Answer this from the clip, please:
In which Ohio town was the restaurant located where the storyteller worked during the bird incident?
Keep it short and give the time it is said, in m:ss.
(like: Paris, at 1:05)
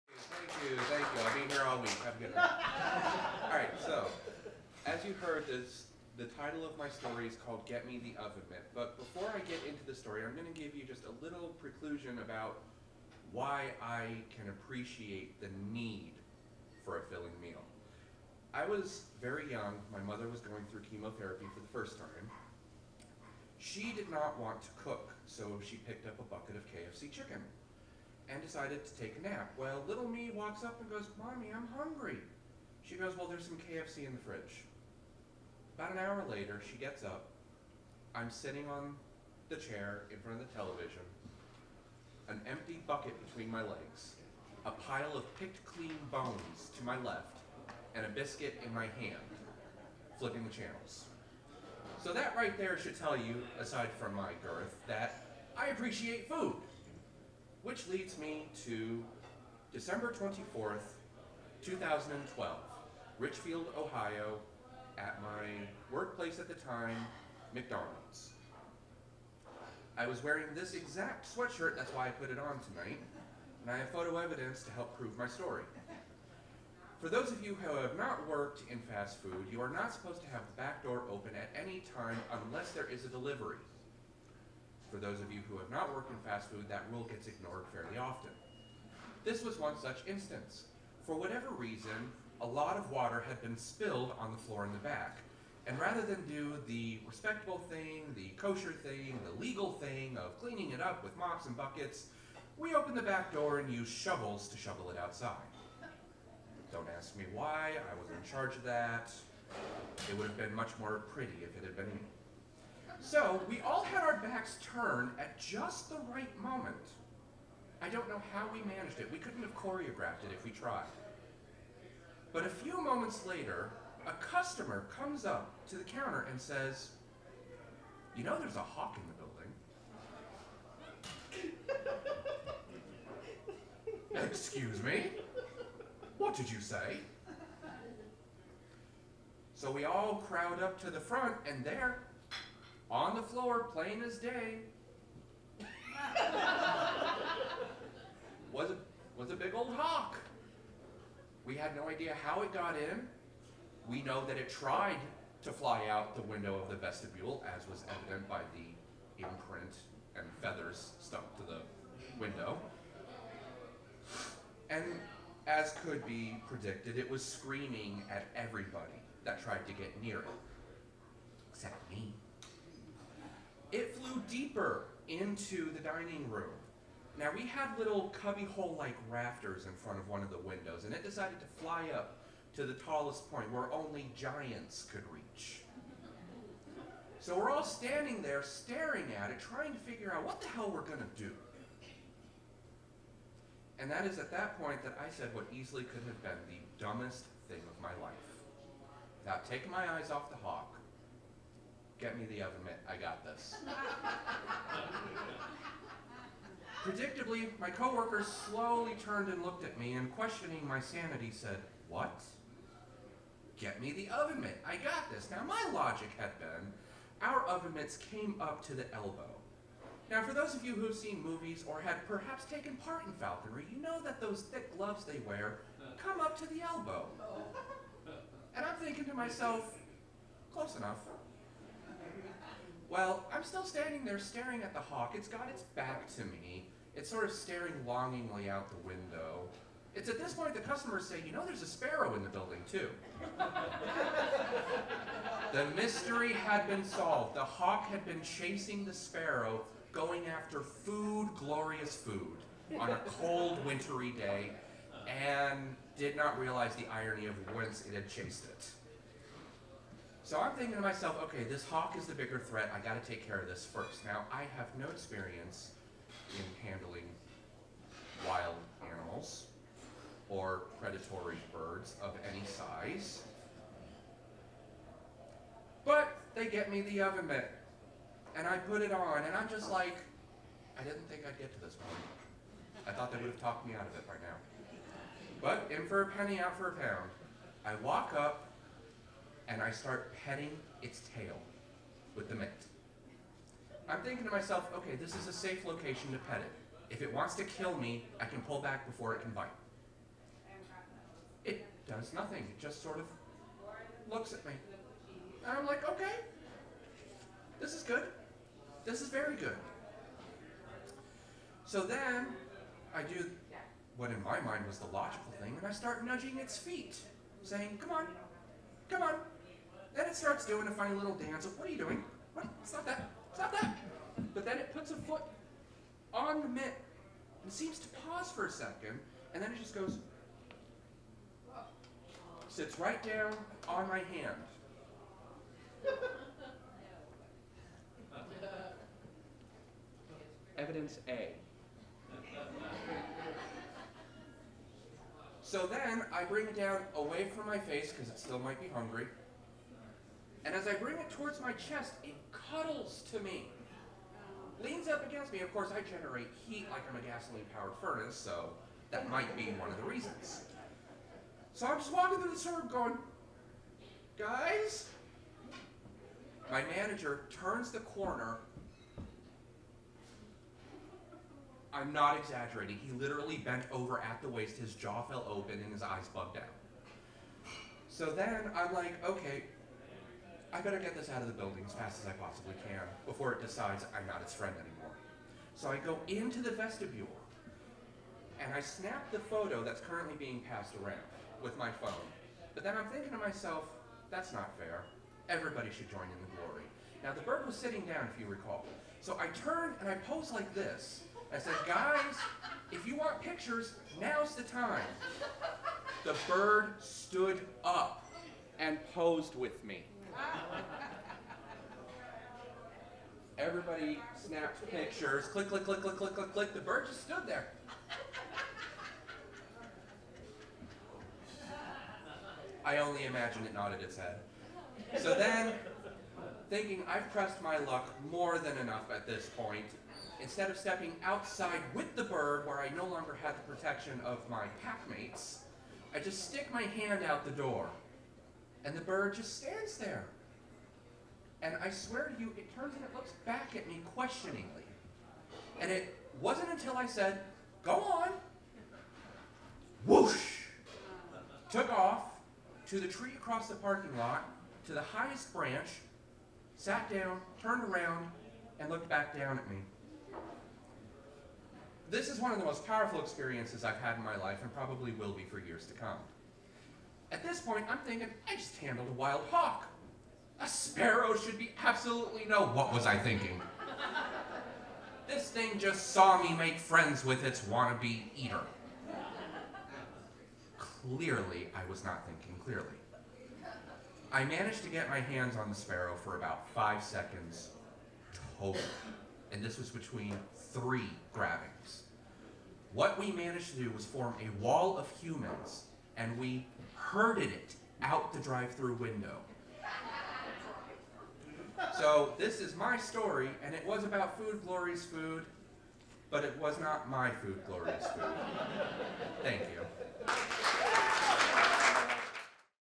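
Richfield, at 1:03.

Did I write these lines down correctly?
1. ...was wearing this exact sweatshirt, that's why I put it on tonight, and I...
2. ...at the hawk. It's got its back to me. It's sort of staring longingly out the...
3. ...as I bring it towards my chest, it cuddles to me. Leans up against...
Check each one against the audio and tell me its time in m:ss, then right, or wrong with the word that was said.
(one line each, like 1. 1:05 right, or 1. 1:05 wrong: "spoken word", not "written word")
1. 1:10 right
2. 3:54 right
3. 5:50 right.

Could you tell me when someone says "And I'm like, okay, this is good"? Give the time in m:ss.
5:05.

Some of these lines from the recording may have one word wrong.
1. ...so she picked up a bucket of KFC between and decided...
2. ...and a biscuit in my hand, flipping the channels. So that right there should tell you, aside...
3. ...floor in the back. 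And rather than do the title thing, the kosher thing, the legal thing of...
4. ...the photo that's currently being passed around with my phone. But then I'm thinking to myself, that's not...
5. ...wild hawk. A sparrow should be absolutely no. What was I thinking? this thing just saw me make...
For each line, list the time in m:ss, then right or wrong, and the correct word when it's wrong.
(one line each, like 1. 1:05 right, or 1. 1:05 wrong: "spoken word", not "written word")
1. 0:25 wrong: "chicken", not "between"
2. 0:47 right
3. 1:34 wrong: "respectable", not "title"
4. 6:29 right
5. 7:48 right.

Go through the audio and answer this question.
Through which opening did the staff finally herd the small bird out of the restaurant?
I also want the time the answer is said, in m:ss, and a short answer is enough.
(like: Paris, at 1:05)
Drive-through window, at 8:18.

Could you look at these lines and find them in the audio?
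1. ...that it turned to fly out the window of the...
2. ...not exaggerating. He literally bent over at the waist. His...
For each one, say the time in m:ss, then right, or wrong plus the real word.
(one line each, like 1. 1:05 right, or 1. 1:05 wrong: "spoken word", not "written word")
1. 2:34 wrong: "tried", not "turned"
2. 6:11 right.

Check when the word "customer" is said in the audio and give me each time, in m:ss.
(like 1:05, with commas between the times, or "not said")
2:04, 4:00.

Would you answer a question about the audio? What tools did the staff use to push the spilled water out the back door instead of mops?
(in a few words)
Shovels.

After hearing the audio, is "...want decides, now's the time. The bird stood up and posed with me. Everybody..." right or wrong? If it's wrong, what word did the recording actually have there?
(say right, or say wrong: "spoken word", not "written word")
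wrong: "pictures", not "decides".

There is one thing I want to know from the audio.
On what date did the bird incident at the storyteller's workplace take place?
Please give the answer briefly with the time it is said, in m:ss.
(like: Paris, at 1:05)
December 24th, 2012, at 0:59.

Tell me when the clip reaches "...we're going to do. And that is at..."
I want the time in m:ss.
3:10.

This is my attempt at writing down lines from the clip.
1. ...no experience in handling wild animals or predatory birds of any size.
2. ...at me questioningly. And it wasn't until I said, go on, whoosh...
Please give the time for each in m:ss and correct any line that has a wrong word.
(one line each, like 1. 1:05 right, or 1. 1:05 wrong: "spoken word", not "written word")
1. 4:24 right
2. 7:23 right.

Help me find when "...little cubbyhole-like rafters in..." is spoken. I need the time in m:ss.
2:57.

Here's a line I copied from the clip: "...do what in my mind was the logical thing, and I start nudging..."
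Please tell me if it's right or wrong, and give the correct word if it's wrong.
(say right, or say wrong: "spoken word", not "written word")
right.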